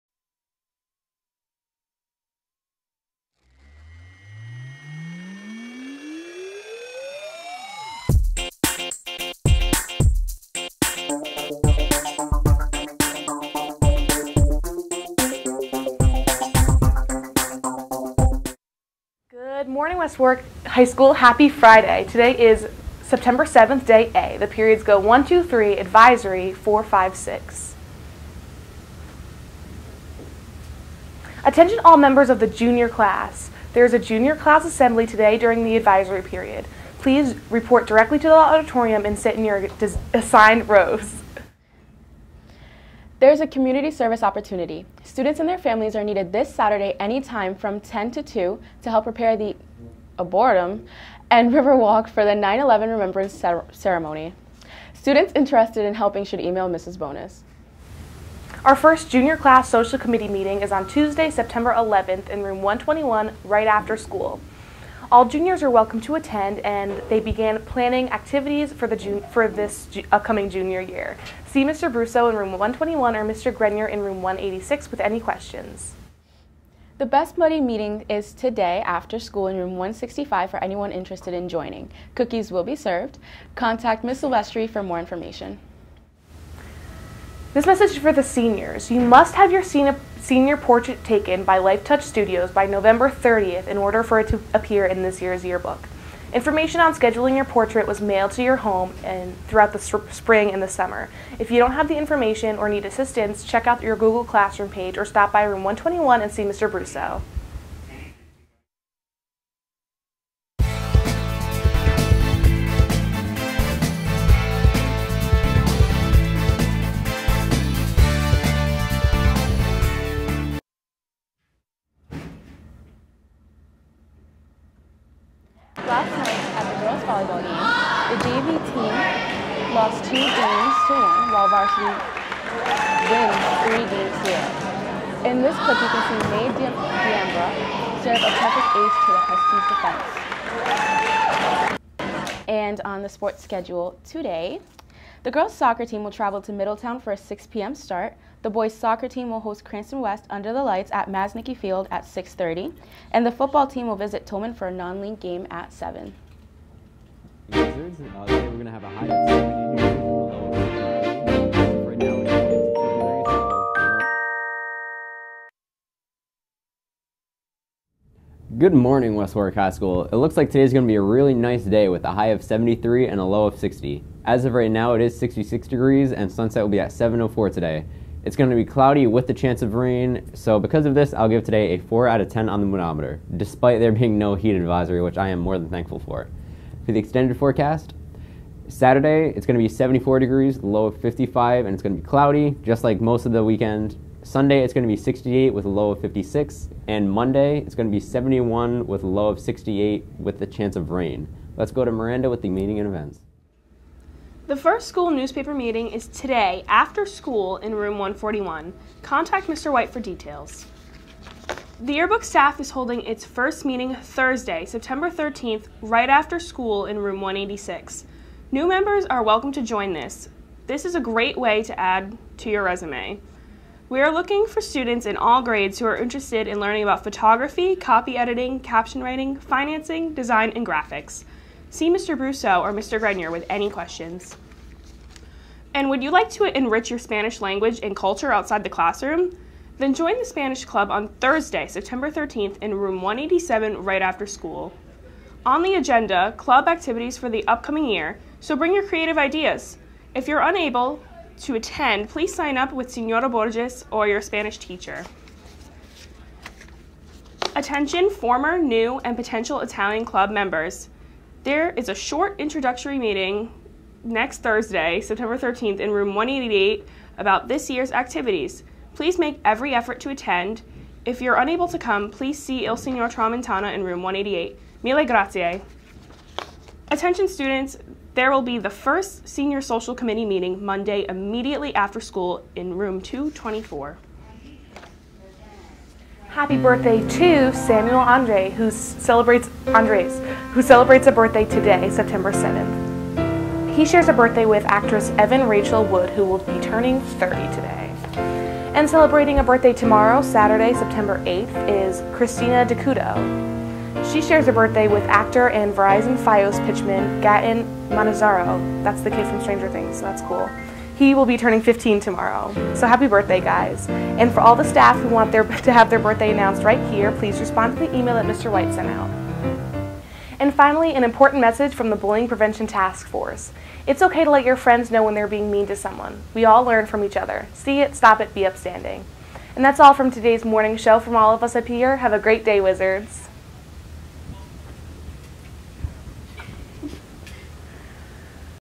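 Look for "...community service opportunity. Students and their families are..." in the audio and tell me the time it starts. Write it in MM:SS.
00:43.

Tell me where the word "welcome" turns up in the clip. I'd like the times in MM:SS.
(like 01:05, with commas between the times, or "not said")
01:05, 03:39.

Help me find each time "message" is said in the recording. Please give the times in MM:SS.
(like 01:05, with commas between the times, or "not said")
01:27, 05:21.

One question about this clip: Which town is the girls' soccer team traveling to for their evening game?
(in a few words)
Middletown.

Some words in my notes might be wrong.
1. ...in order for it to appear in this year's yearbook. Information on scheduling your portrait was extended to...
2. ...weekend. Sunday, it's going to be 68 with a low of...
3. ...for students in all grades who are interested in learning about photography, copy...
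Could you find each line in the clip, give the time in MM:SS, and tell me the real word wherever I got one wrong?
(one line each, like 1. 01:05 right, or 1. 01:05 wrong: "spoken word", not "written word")
1. 01:33 wrong: "mailed", not "extended"
2. 03:13 right
3. 03:44 right.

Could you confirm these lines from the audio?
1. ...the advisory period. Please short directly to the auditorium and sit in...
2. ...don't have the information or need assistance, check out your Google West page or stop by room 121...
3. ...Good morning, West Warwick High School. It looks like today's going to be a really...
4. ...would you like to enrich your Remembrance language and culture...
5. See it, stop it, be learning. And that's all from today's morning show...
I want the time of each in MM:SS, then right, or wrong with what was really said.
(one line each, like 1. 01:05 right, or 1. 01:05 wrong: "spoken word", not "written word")
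1. 00:35 wrong: "report", not "short"
2. 01:41 wrong: "Classroom", not "West"
3. 02:48 right
4. 03:55 wrong: "Spanish", not "Remembrance"
5. 05:27 wrong: "upstanding", not "learning".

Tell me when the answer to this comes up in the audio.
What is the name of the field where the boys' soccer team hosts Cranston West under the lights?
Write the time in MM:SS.
02:31.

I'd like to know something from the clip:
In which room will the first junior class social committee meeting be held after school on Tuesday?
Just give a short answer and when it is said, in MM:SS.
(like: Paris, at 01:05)
Room 121, at 01:02.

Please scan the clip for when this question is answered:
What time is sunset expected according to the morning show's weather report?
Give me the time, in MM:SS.
02:56.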